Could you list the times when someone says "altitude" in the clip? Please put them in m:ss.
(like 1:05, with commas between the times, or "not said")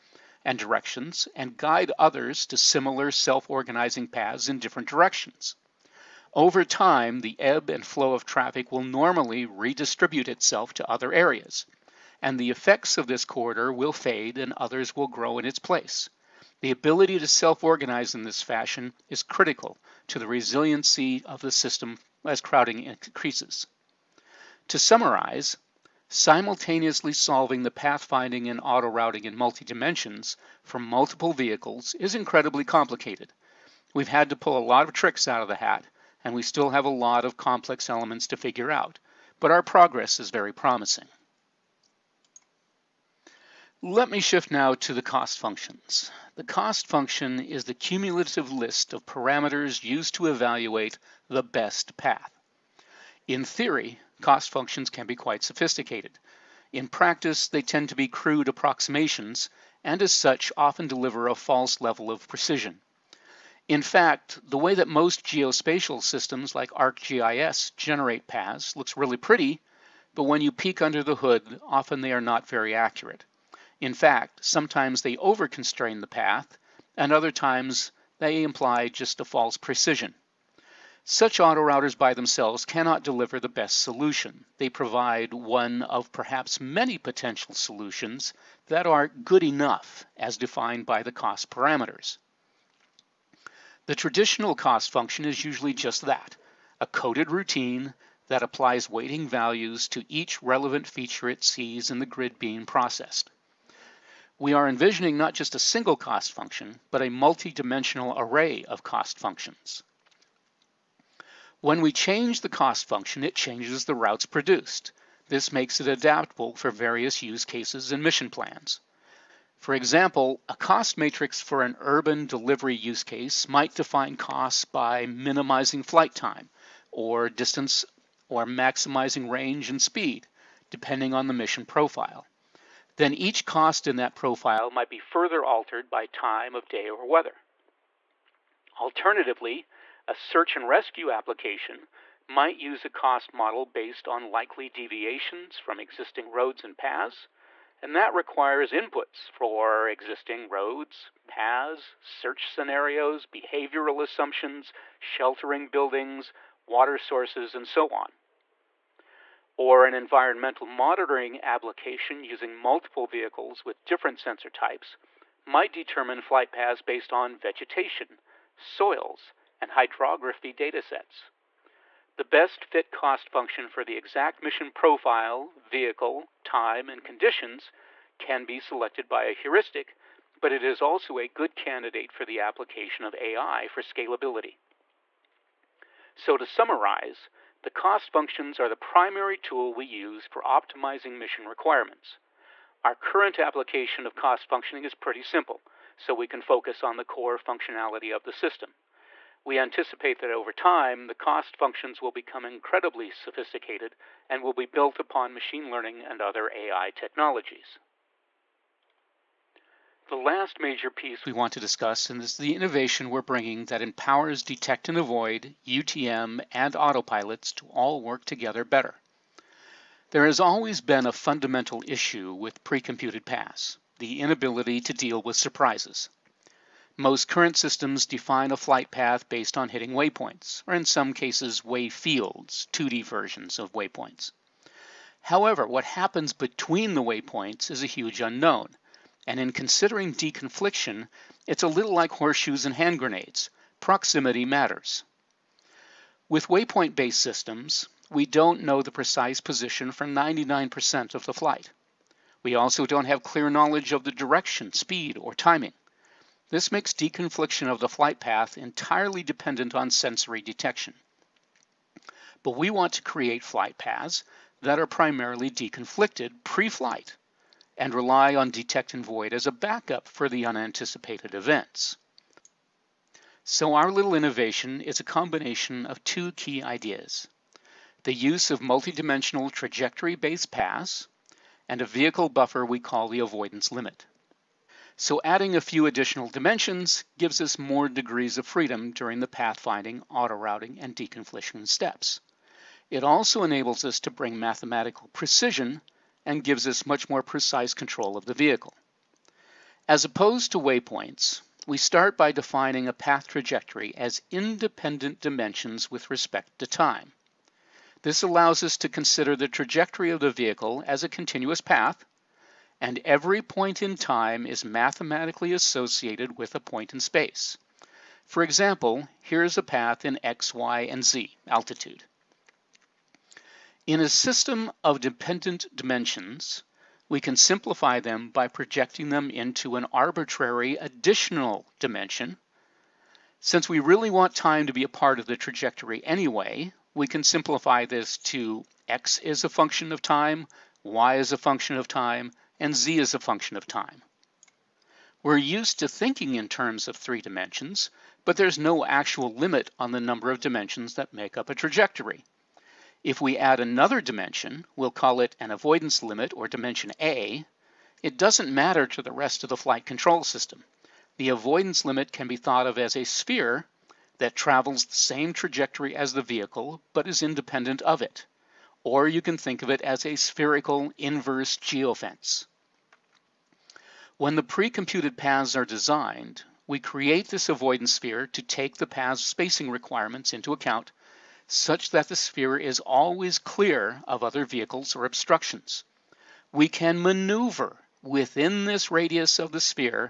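5:21.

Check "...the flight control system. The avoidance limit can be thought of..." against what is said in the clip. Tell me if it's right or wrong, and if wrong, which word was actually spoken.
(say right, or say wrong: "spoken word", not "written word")
right.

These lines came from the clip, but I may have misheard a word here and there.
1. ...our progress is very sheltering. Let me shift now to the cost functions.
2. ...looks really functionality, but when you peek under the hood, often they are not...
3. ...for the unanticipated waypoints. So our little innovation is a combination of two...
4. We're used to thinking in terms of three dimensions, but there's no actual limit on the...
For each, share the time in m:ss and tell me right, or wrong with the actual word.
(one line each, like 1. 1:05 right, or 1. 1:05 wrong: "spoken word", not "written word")
1. 0:39 wrong: "promising", not "sheltering"
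2. 1:08 wrong: "pretty", not "functionality"
3. 4:30 wrong: "events", not "waypoints"
4. 5:45 right.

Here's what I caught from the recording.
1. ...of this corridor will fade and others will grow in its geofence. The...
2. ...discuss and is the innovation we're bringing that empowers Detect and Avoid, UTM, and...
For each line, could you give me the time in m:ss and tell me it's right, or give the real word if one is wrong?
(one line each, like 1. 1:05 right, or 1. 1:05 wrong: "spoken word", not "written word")
1. 0:12 wrong: "place", not "geofence"
2. 3:31 right.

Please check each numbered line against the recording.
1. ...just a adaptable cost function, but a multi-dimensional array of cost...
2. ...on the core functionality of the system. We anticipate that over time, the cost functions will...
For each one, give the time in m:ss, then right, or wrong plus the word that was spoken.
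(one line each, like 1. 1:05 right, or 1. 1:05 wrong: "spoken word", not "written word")
1. 1:45 wrong: "single", not "adaptable"
2. 3:16 right.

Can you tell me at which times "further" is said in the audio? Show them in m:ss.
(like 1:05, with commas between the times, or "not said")
2:14.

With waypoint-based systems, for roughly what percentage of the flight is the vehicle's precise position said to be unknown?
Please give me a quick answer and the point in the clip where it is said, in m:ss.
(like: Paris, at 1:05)
99%, at 4:10.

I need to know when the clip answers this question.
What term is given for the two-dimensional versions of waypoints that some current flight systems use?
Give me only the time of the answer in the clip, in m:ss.
3:51.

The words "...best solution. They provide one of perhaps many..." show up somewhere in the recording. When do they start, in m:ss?
1:23.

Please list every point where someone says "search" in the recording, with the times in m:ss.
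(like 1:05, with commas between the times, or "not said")
2:20, 2:32.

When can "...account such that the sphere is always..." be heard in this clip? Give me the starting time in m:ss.
6:20.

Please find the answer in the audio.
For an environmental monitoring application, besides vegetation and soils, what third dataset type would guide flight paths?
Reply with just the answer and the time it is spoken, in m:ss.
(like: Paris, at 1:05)
hydrography, at 2:49.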